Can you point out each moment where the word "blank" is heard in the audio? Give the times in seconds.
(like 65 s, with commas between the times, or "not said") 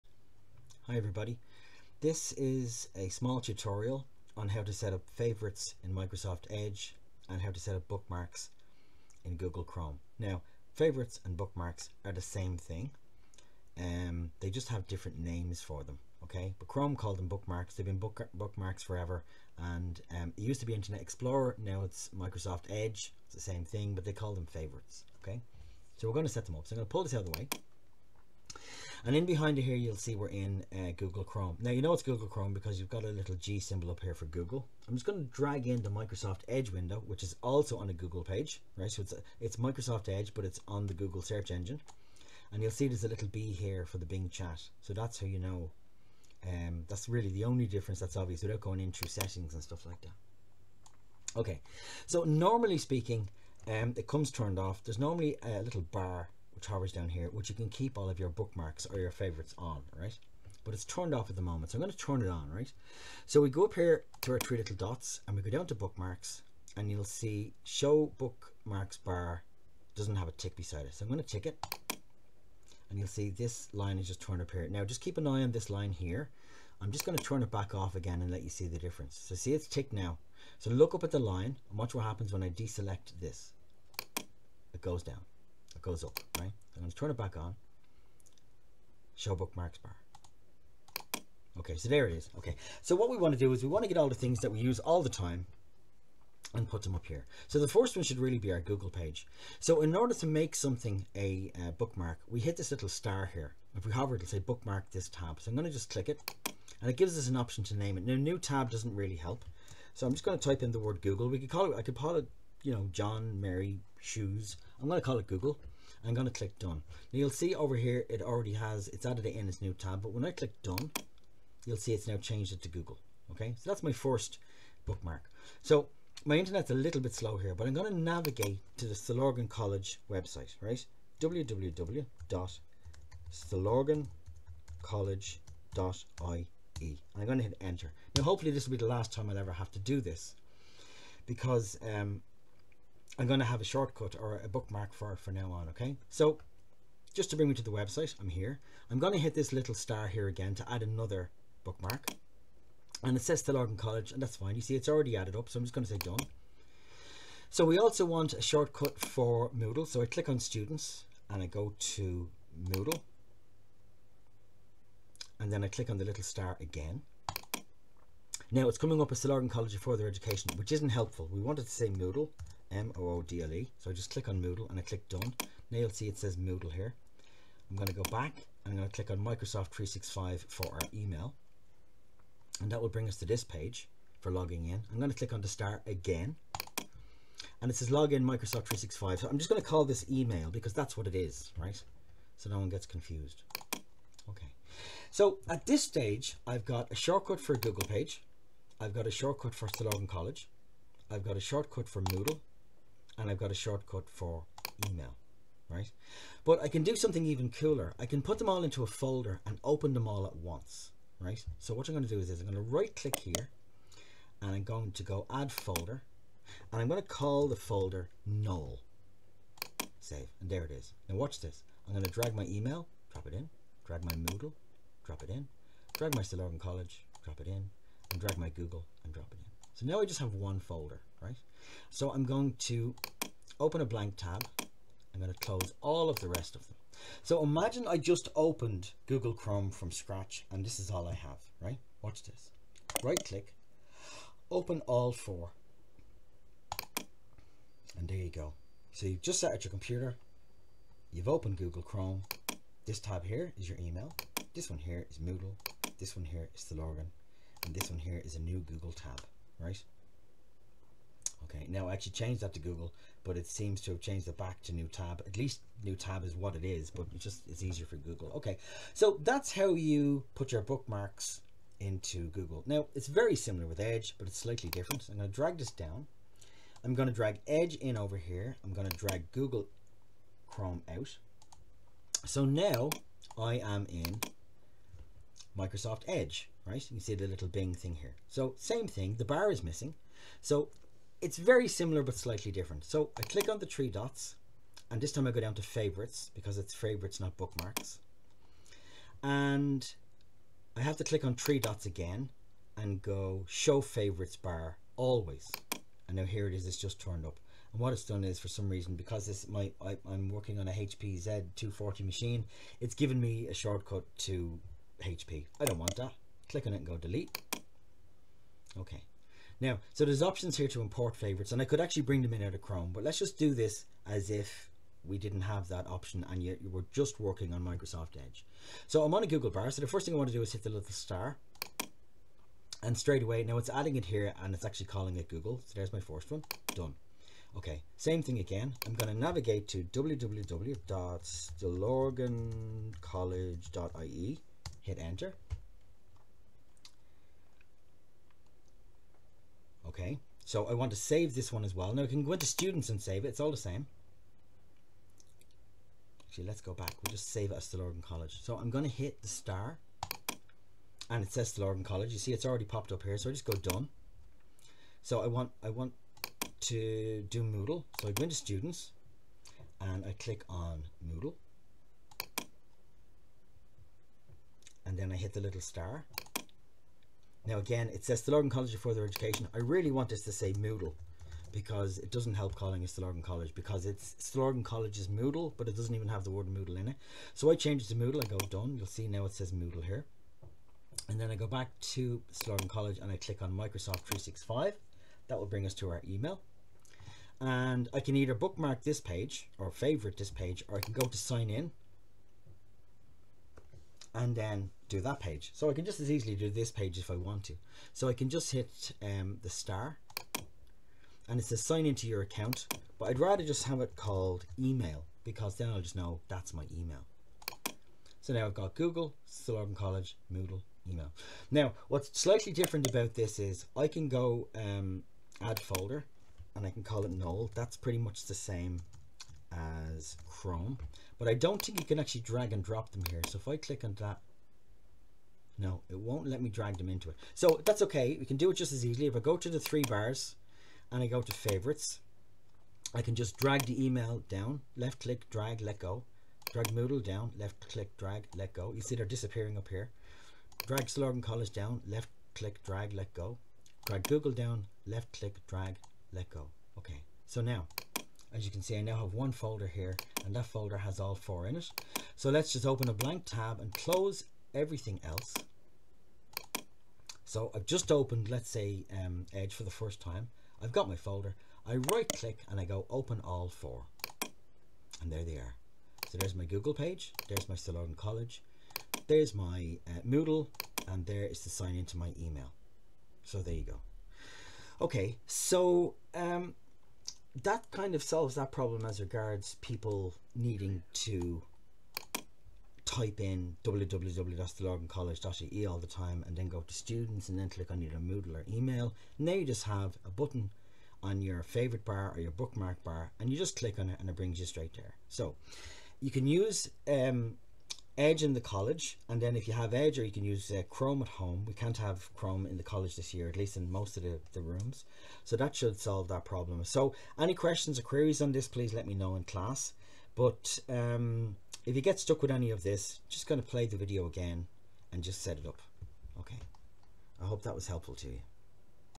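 233 s, 462 s.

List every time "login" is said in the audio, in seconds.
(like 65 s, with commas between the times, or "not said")
187 s, 256 s.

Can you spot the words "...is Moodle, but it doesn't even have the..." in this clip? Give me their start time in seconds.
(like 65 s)
384 s.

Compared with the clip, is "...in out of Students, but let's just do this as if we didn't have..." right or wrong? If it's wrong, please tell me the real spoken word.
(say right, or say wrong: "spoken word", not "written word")
wrong: "Chrome", not "Students".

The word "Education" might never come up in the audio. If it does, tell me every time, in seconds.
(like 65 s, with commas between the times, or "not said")
170 s, 379 s.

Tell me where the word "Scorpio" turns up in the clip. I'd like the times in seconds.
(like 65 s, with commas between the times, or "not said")
not said.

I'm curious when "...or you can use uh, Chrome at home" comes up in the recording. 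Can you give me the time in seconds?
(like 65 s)
509 s.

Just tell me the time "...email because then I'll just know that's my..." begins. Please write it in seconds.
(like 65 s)
414 s.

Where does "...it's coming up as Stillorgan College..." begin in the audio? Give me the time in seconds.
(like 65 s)
168 s.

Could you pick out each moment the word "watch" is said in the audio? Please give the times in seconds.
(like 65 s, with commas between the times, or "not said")
81 s, 221 s, 242 s.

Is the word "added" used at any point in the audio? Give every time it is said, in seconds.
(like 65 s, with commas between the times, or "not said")
119 s, 155 s.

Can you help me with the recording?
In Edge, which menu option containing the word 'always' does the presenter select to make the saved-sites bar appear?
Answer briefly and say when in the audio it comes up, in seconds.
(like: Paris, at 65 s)
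Show favorites bar always, at 303 s.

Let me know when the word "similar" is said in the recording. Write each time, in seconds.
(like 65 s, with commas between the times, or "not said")
273 s, 291 s.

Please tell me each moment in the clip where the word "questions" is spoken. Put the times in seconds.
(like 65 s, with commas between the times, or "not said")
517 s.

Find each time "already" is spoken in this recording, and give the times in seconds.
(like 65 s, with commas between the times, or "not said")
118 s, 154 s, 362 s.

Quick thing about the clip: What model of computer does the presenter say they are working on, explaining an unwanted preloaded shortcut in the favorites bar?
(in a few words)
HP Z240.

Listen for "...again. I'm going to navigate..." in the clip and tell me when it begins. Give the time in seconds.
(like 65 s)
338 s.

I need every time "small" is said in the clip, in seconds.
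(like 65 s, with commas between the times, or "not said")
3 s.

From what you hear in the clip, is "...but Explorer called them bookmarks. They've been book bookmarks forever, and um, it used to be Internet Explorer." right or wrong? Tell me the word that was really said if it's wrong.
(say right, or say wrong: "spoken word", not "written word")
wrong: "Chrome", not "Explorer".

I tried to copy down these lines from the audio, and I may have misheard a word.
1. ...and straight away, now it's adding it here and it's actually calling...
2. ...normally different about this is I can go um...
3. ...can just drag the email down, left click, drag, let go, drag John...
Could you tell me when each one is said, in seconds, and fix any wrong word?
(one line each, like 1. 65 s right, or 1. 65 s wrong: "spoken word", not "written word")
1. 332 s right
2. 422 s wrong: "slightly", not "normally"
3. 443 s wrong: "Moodle", not "John".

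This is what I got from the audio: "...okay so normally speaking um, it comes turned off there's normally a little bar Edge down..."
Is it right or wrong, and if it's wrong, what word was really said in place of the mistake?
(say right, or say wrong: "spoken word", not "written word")
wrong: "Towers", not "Edge".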